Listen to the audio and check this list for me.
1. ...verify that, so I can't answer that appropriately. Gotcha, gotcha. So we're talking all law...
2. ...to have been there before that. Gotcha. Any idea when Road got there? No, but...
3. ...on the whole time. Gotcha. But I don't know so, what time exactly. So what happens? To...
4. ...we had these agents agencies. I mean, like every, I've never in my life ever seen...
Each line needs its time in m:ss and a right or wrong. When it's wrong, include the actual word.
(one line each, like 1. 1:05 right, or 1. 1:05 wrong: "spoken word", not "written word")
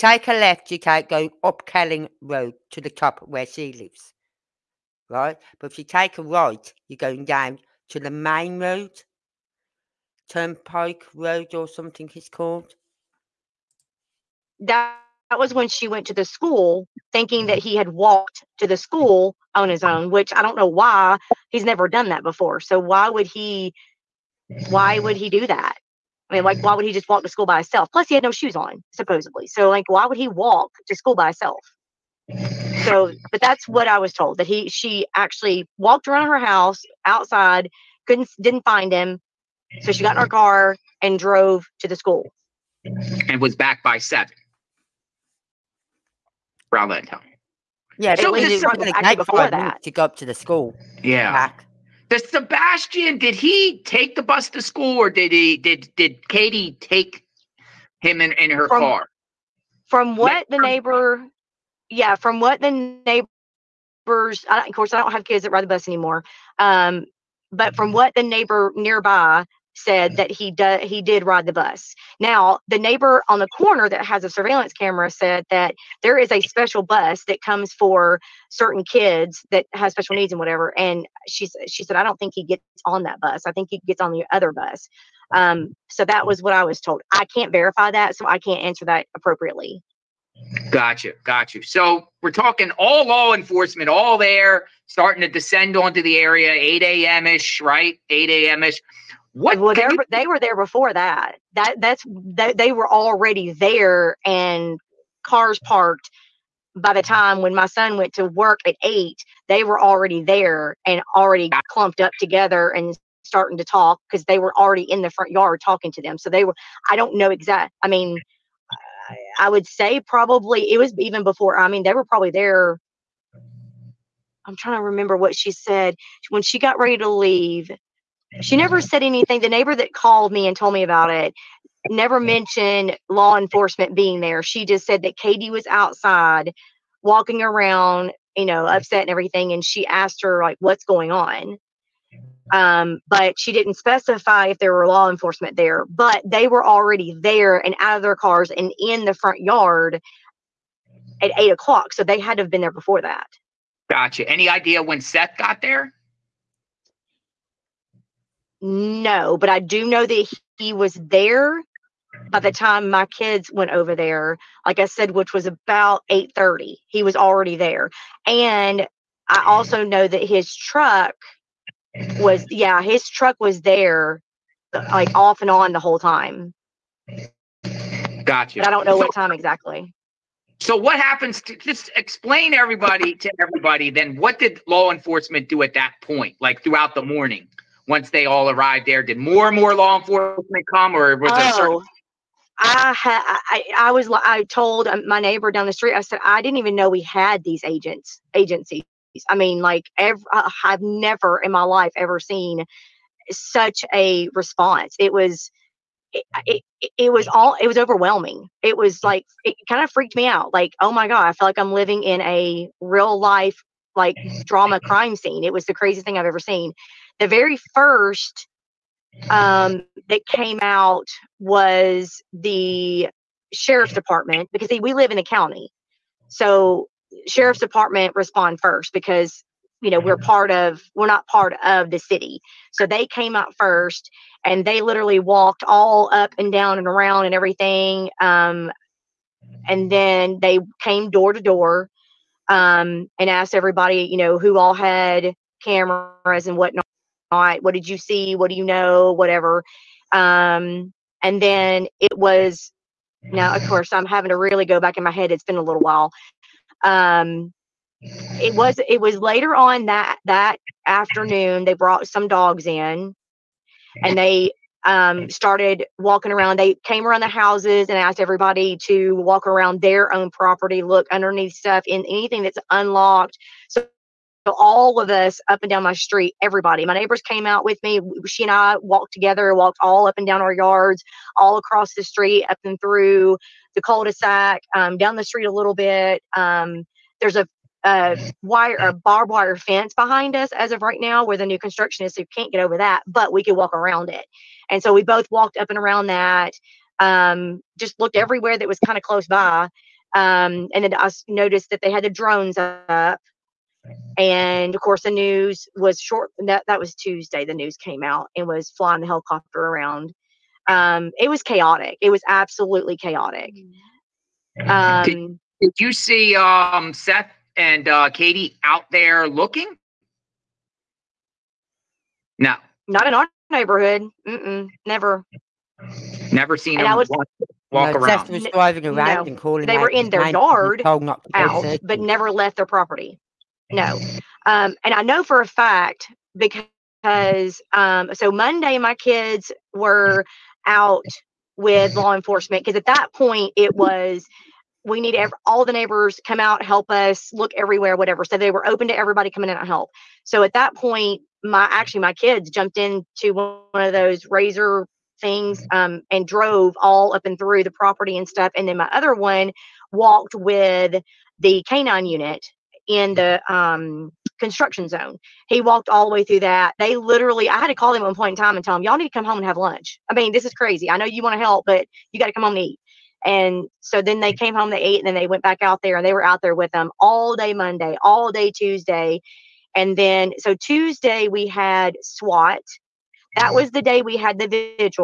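1. 1:27 right
2. 2:32 wrong: "Seth", not "Road"
3. 2:55 right
4. 3:16 right.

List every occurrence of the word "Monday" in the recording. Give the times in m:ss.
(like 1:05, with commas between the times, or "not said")
5:38, 6:17.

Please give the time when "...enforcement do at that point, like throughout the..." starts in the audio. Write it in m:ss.
3:04.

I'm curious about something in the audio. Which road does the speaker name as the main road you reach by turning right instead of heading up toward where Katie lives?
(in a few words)
Turnpike Road.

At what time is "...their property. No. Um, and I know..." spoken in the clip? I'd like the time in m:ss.
5:32.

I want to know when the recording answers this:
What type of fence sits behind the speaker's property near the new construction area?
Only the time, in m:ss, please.
4:48.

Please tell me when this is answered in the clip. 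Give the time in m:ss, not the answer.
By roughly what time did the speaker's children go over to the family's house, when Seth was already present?
2:46.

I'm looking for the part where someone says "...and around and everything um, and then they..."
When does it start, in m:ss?
3:56.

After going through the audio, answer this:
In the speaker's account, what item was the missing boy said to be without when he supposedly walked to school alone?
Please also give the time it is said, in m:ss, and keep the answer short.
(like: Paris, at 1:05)
Shoes, at 0:28.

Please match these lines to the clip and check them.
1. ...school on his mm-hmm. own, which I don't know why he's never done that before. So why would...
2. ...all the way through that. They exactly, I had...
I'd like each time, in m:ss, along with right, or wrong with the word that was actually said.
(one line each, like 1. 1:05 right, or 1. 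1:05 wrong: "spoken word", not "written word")
1. 0:18 right
2. 6:05 wrong: "literally", not "exactly".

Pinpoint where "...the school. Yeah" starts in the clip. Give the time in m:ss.
0:50.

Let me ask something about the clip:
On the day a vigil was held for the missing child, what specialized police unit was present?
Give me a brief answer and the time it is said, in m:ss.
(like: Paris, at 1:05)
SWAT, at 6:22.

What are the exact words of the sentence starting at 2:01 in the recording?
I mean, they were probably there.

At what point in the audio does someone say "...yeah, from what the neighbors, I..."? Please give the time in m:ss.
1:01.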